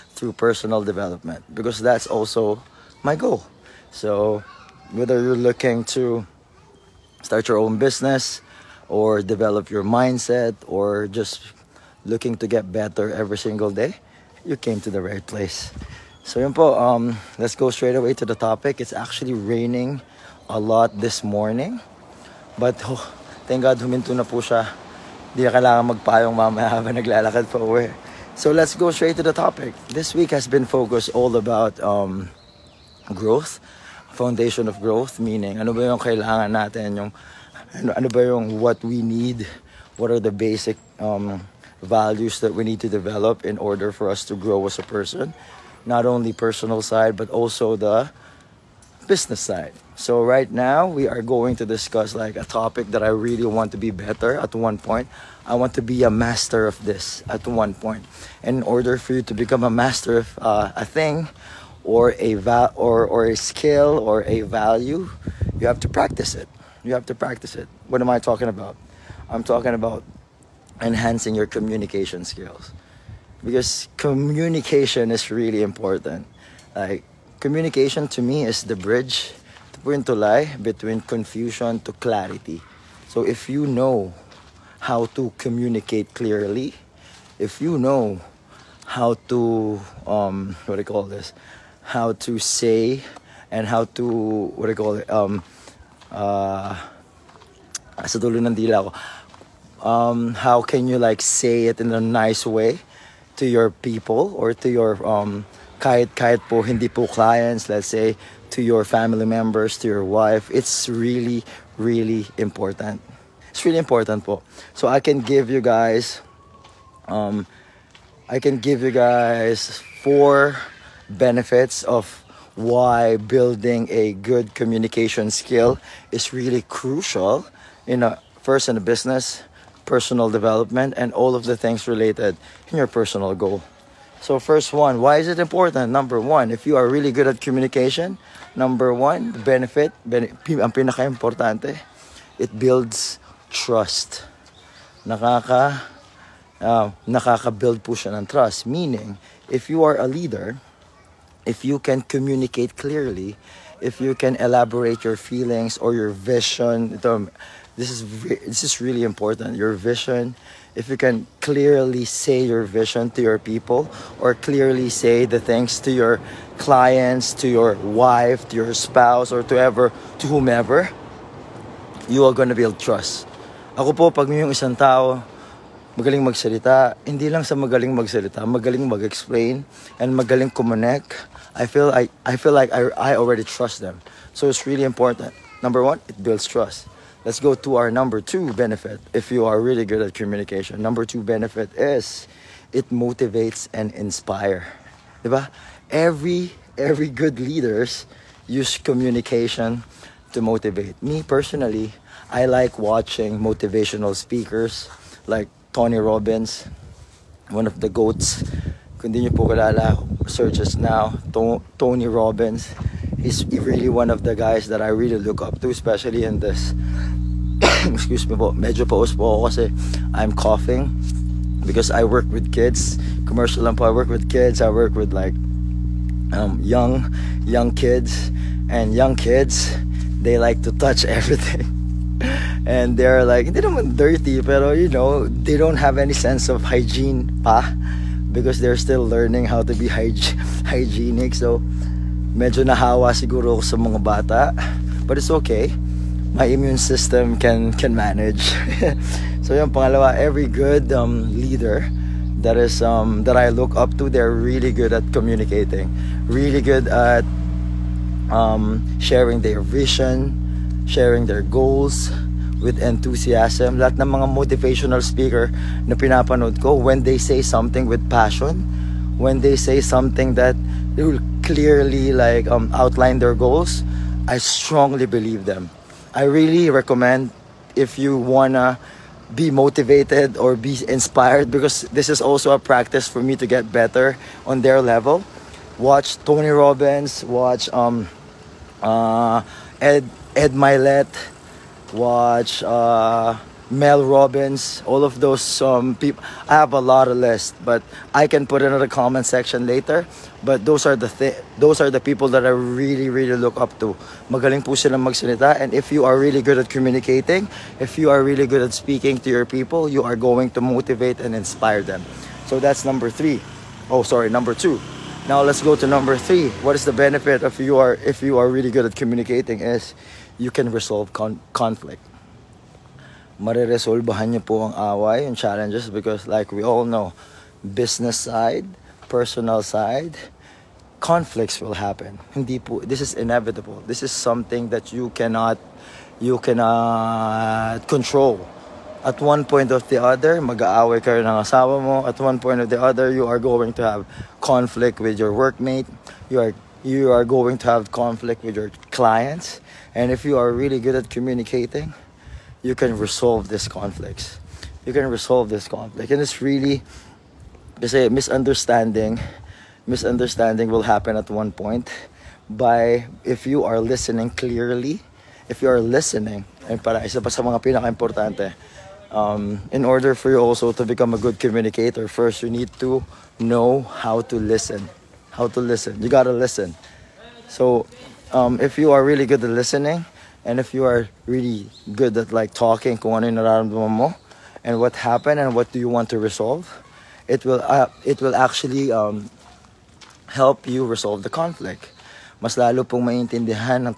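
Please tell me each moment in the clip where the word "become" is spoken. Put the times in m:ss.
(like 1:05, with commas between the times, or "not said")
0:59, 6:10.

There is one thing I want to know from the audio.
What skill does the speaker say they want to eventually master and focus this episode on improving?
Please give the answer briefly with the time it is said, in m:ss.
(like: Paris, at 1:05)
communication skills, at 1:11.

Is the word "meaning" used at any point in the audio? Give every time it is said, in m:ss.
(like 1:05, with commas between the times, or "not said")
0:35, 2:28.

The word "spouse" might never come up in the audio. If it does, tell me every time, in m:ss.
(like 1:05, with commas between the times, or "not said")
2:48.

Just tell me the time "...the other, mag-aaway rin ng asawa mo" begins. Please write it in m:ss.
5:39.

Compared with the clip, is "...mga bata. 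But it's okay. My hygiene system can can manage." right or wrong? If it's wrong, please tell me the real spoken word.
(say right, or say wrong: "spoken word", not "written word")
wrong: "immune", not "hygiene".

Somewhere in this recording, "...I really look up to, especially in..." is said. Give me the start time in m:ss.
3:34.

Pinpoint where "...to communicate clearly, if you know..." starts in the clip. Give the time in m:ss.
1:25.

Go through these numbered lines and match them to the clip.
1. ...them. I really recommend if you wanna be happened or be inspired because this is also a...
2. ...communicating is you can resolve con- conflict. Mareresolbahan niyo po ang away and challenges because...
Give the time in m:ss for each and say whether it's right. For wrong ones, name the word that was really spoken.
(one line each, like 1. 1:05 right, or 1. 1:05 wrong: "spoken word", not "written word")
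1. 4:35 wrong: "motivated", not "happened"
2. 5:18 right.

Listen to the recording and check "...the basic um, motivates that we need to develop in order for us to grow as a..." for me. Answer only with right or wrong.
wrong.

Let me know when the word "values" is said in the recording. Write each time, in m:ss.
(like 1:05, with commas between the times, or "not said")
0:41, 1:04.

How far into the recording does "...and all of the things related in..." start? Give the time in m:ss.
2:10.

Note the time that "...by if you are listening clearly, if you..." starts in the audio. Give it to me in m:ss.
6:02.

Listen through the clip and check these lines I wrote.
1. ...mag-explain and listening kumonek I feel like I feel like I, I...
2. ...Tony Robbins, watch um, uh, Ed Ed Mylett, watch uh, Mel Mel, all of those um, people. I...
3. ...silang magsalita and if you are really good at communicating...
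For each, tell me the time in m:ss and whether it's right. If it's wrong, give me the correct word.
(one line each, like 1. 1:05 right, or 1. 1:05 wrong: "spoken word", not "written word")
1. 2:58 wrong: "magaling", not "listening"
2. 4:46 wrong: "Robbins", not "Mel"
3. 5:04 right.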